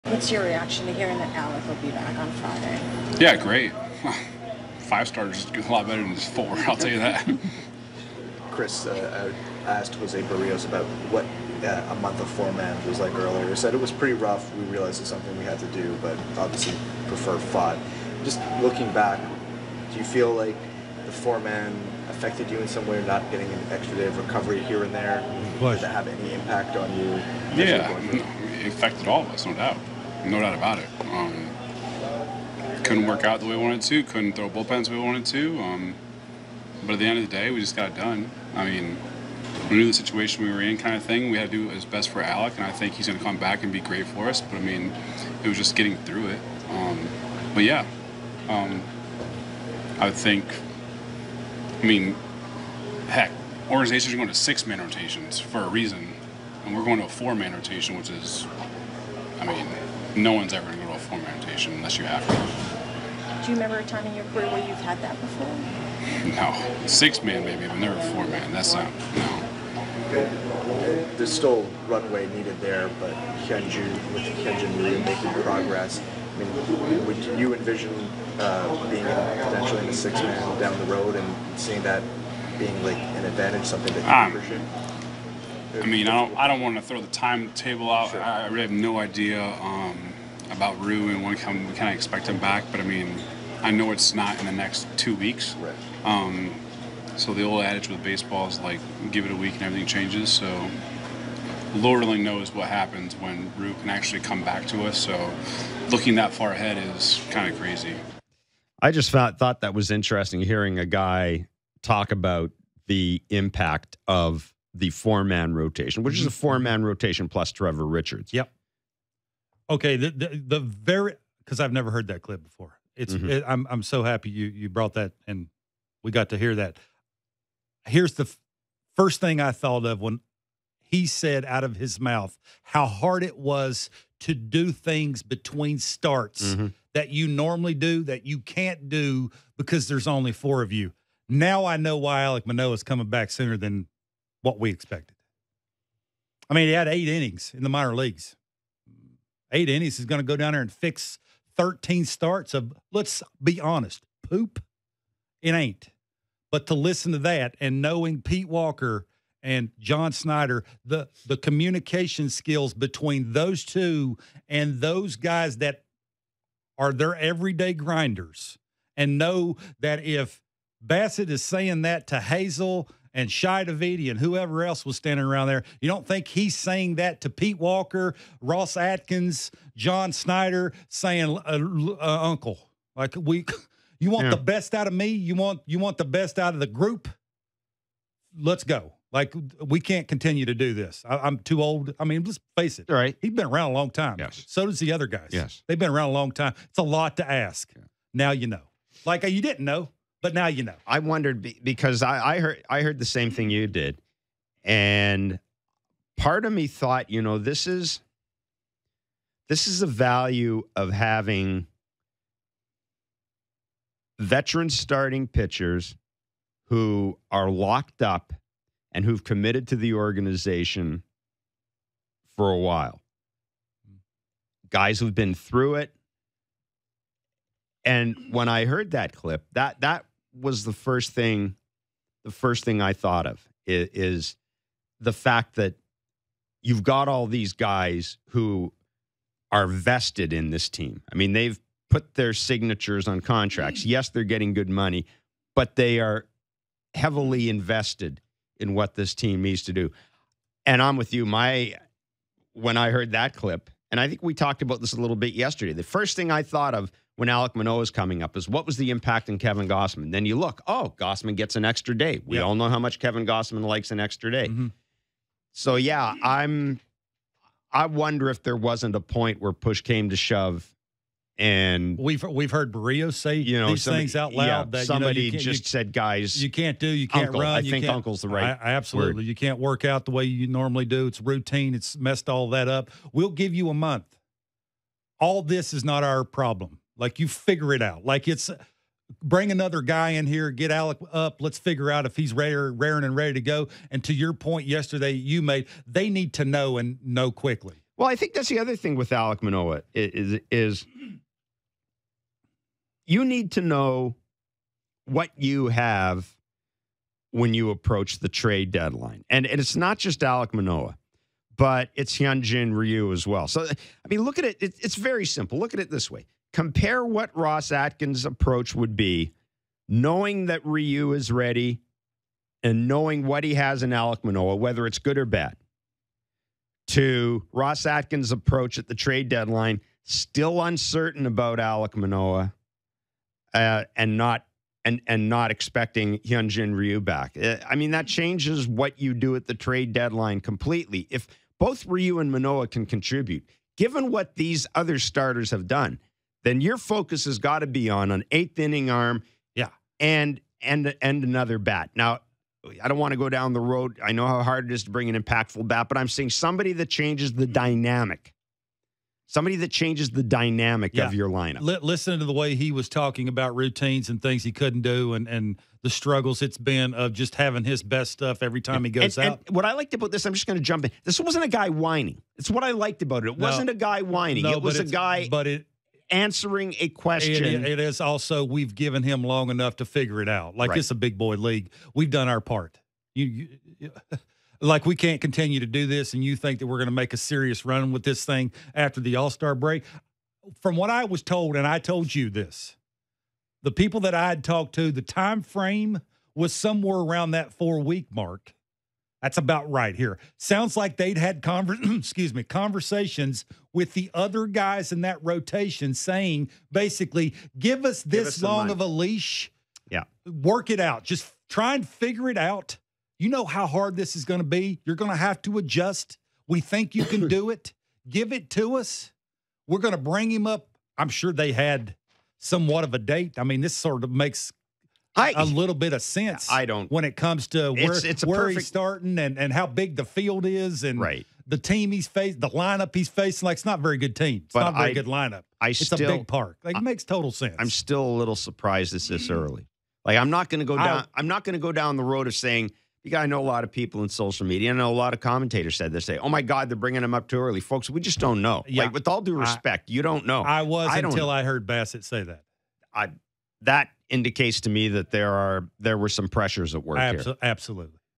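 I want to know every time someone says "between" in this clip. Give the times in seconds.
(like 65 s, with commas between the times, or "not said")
135 s, 162 s.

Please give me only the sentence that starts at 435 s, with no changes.
I it's still, a big park.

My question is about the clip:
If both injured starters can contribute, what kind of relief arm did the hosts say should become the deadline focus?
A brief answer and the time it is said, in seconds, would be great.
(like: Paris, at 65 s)
Eighth inning arm, at 348 s.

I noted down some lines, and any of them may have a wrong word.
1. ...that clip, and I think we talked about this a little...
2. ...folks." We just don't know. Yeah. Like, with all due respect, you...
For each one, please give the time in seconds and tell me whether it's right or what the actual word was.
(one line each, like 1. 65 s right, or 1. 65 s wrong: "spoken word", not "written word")
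1. 253 s right
2. 447 s right.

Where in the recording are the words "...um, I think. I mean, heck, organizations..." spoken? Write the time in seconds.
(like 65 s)
48 s.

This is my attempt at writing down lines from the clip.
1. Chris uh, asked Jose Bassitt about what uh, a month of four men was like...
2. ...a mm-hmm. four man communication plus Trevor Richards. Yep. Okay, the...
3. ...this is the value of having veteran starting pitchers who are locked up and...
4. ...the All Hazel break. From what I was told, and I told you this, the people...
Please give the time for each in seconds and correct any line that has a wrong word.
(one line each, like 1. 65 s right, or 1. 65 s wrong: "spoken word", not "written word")
1. 8 s wrong: "Berríos", not "Bassitt"
2. 116 s wrong: "rotation", not "communication"
3. 209 s right
4. 388 s wrong: "Star", not "Hazel".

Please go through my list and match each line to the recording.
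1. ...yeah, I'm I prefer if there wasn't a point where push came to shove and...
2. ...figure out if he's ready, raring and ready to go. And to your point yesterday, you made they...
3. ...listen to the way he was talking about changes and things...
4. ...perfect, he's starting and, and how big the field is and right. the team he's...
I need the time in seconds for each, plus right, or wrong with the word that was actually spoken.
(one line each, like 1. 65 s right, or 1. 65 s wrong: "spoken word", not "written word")
1. 265 s wrong: "wonder", not "prefer"
2. 291 s right
3. 361 s wrong: "routines", not "changes"
4. 428 s right.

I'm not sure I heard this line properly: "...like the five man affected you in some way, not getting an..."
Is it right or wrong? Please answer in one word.
wrong.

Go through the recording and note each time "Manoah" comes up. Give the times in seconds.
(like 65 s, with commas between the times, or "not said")
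142 s, 257 s, 299 s, 310 s, 324 s, 331 s, 342 s.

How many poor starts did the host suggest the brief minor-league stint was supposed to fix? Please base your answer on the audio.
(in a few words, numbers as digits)
13.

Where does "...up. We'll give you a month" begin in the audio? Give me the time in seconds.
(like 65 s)
282 s.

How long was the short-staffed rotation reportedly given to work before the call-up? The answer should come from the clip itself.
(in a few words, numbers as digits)
4 weeks.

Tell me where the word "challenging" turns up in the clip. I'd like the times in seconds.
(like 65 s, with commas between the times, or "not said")
not said.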